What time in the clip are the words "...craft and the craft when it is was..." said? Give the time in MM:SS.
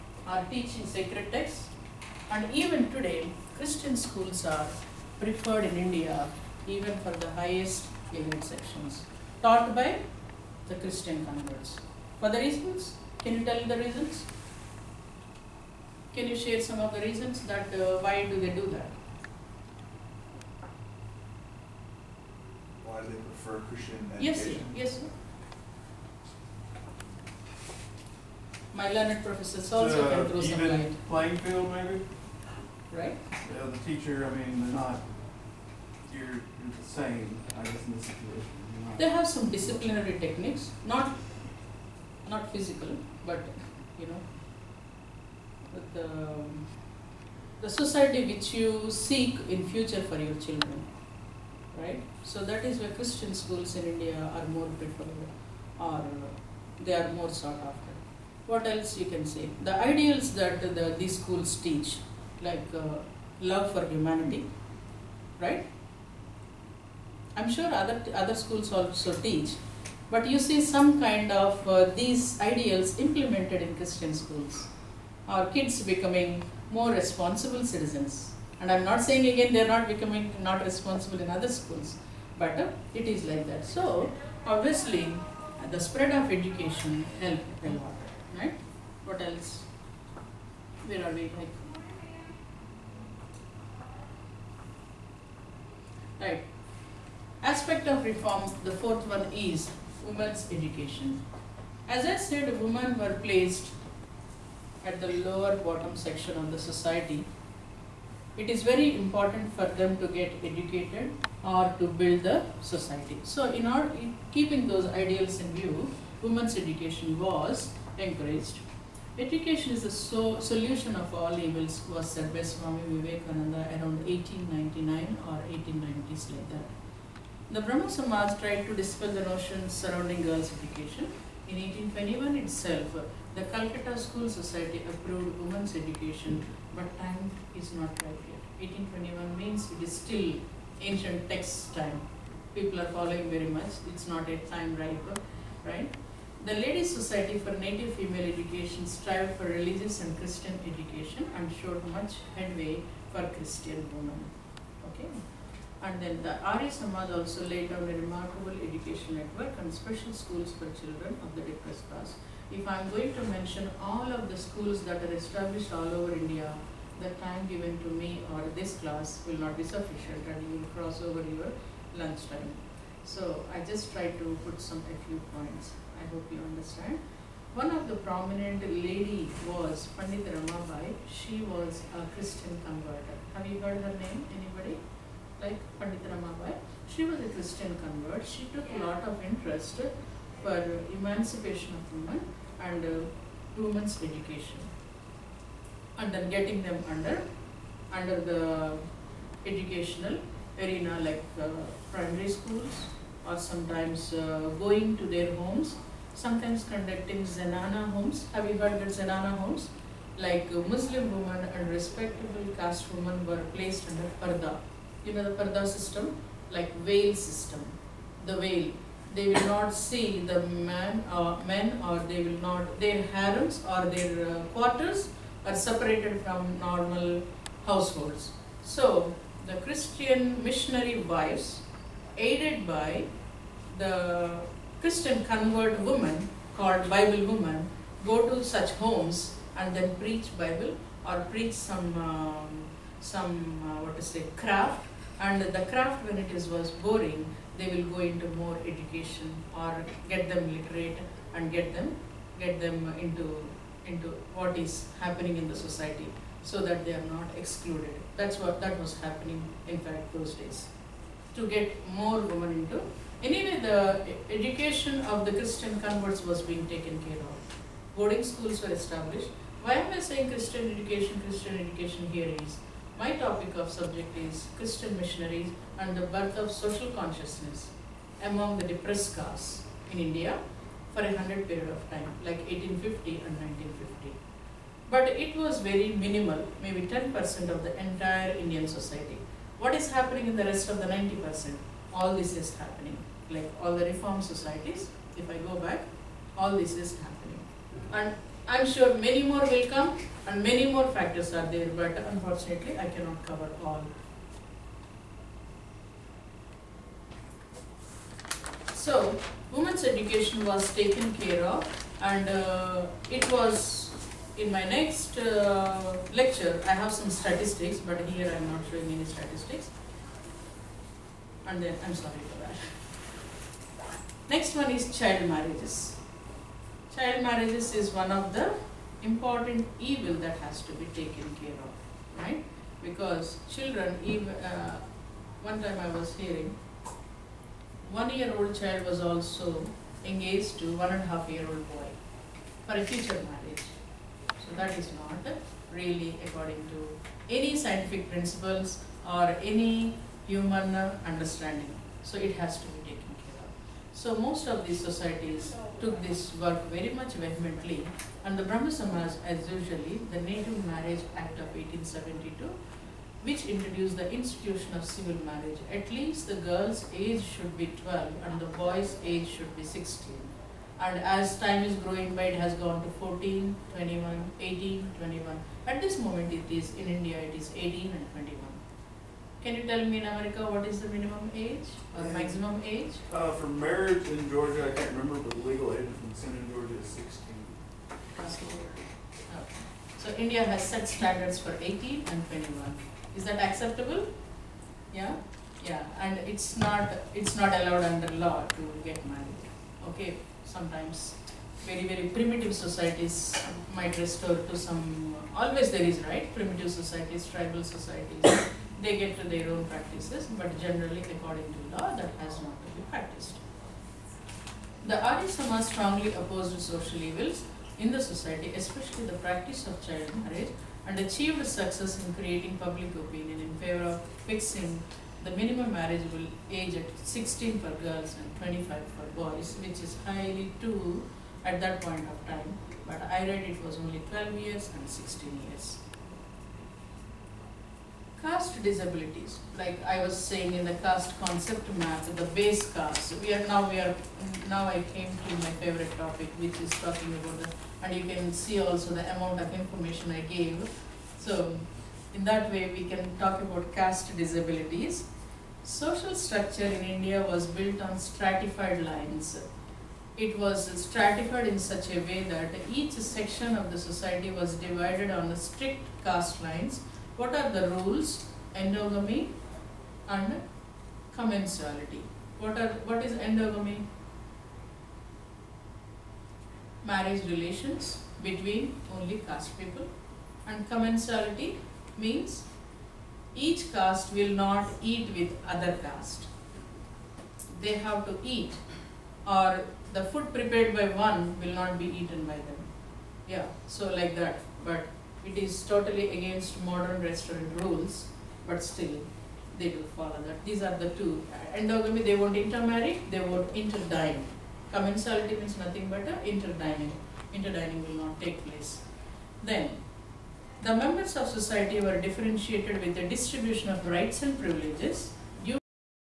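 04:04.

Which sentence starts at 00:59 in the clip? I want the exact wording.
The ideals that the, these schools teach, like uh, love for humanity, right?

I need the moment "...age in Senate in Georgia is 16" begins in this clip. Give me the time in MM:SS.
06:25.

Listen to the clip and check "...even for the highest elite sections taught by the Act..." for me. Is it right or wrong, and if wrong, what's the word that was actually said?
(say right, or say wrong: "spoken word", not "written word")
wrong: "Christian", not "Act".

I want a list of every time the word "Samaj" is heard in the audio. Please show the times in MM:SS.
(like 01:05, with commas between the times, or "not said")
02:07, 02:36, 05:58, 06:55.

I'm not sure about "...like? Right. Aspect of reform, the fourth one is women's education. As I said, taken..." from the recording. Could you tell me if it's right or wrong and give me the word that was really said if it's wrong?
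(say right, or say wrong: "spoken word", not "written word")
wrong: "women", not "taken".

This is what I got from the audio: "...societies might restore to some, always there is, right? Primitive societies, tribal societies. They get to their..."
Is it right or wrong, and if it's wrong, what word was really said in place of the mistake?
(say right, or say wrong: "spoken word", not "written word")
right.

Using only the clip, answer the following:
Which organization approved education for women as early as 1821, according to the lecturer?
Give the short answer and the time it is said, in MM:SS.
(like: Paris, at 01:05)
Calcutta School Society, at 02:13.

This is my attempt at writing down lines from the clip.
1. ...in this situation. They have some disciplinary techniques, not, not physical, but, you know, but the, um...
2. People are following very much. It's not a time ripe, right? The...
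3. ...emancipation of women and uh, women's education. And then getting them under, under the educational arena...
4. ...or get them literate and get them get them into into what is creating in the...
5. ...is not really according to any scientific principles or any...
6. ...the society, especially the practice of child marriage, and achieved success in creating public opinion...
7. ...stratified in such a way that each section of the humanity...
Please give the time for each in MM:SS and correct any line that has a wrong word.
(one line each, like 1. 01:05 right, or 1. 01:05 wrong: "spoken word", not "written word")
1. 00:37 right
2. 02:22 right
3. 03:10 right
4. 04:09 wrong: "happening", not "creating"
5. 05:44 right
6. 06:57 right
7. 07:40 wrong: "society", not "humanity".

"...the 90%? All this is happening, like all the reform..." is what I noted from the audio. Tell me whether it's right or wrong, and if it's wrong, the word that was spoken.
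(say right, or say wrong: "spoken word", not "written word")
right.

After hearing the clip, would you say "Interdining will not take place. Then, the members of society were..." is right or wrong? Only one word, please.
right.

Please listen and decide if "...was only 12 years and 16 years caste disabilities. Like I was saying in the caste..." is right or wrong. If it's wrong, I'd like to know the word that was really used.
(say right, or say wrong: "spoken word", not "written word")
right.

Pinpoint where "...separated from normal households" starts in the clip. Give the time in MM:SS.
03:45.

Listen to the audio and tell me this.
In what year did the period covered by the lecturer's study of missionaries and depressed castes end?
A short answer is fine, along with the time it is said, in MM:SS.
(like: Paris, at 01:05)
1950, at 04:43.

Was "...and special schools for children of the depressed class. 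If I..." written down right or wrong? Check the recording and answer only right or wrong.
right.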